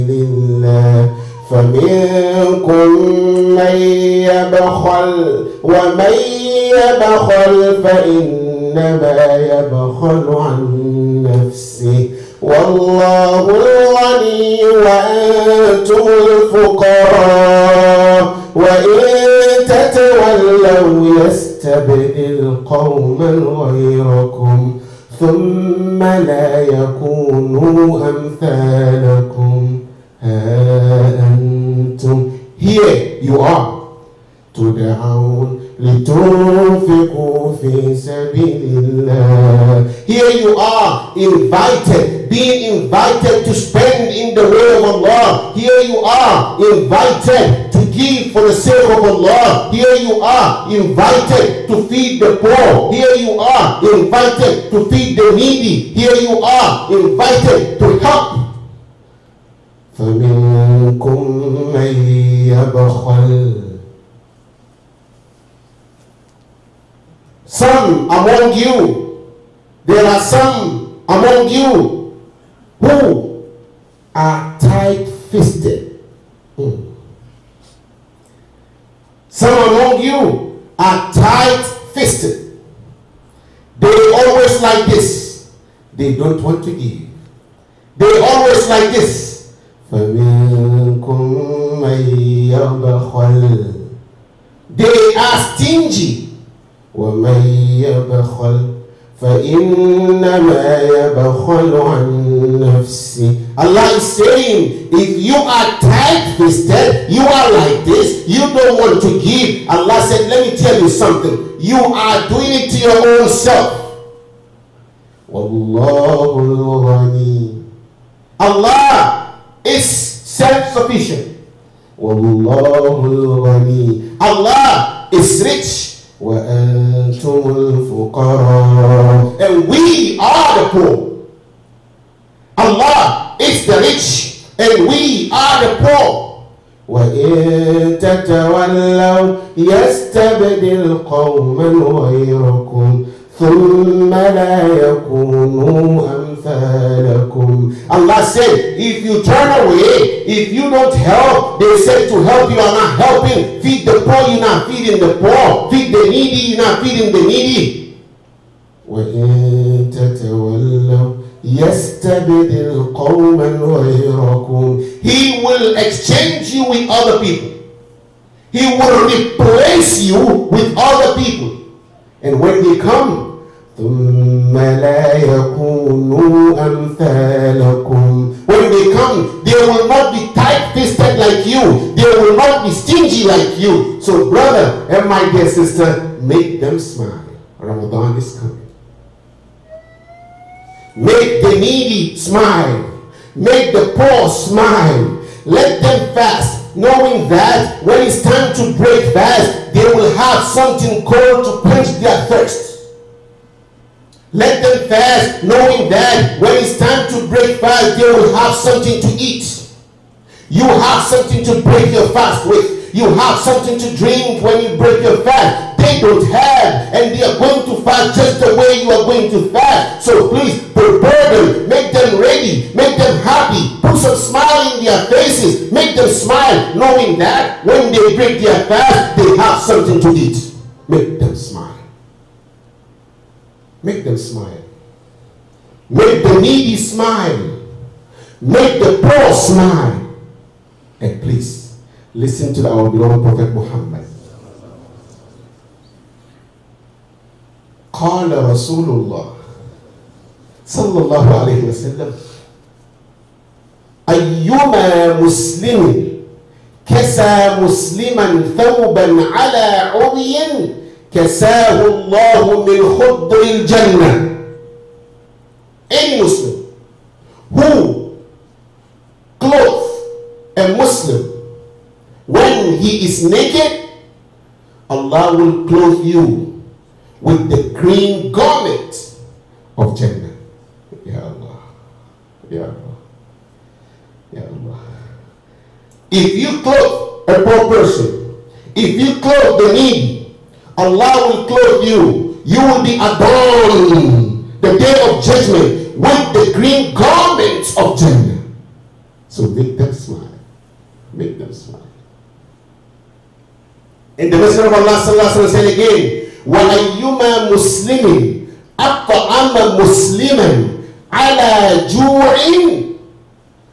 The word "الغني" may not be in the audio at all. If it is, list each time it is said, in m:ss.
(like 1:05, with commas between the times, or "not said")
0:13.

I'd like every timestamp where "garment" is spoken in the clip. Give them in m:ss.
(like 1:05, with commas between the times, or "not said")
4:38, 4:56.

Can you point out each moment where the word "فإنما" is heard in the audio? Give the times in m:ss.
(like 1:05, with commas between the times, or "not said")
0:07, 1:39.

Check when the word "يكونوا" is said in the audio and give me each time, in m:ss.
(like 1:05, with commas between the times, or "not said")
0:26.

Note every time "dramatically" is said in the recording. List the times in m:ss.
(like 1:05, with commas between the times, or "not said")
not said.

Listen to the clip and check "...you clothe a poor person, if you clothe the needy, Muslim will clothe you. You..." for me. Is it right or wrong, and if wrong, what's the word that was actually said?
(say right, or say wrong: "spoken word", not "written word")
wrong: "Allah", not "Muslim".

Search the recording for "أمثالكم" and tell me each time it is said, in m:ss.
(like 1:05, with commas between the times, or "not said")
0:28, 2:26.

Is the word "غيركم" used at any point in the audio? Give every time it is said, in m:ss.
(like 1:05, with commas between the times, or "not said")
0:23, 2:21, 2:43.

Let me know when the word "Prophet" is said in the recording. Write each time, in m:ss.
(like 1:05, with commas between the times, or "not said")
4:03.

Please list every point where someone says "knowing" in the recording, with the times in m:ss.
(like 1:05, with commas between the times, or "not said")
3:16, 3:25, 3:46.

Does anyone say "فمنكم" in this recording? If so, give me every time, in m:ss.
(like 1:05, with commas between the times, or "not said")
0:01, 0:59.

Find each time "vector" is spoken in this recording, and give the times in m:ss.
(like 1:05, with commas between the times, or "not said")
not said.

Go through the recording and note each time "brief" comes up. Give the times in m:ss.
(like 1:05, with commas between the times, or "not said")
not said.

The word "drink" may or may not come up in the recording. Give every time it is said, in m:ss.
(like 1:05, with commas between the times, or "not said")
3:33.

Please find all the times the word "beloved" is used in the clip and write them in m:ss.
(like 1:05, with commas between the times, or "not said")
4:02.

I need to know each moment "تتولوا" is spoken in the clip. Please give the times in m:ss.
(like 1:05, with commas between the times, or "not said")
0:19, 2:17, 2:39.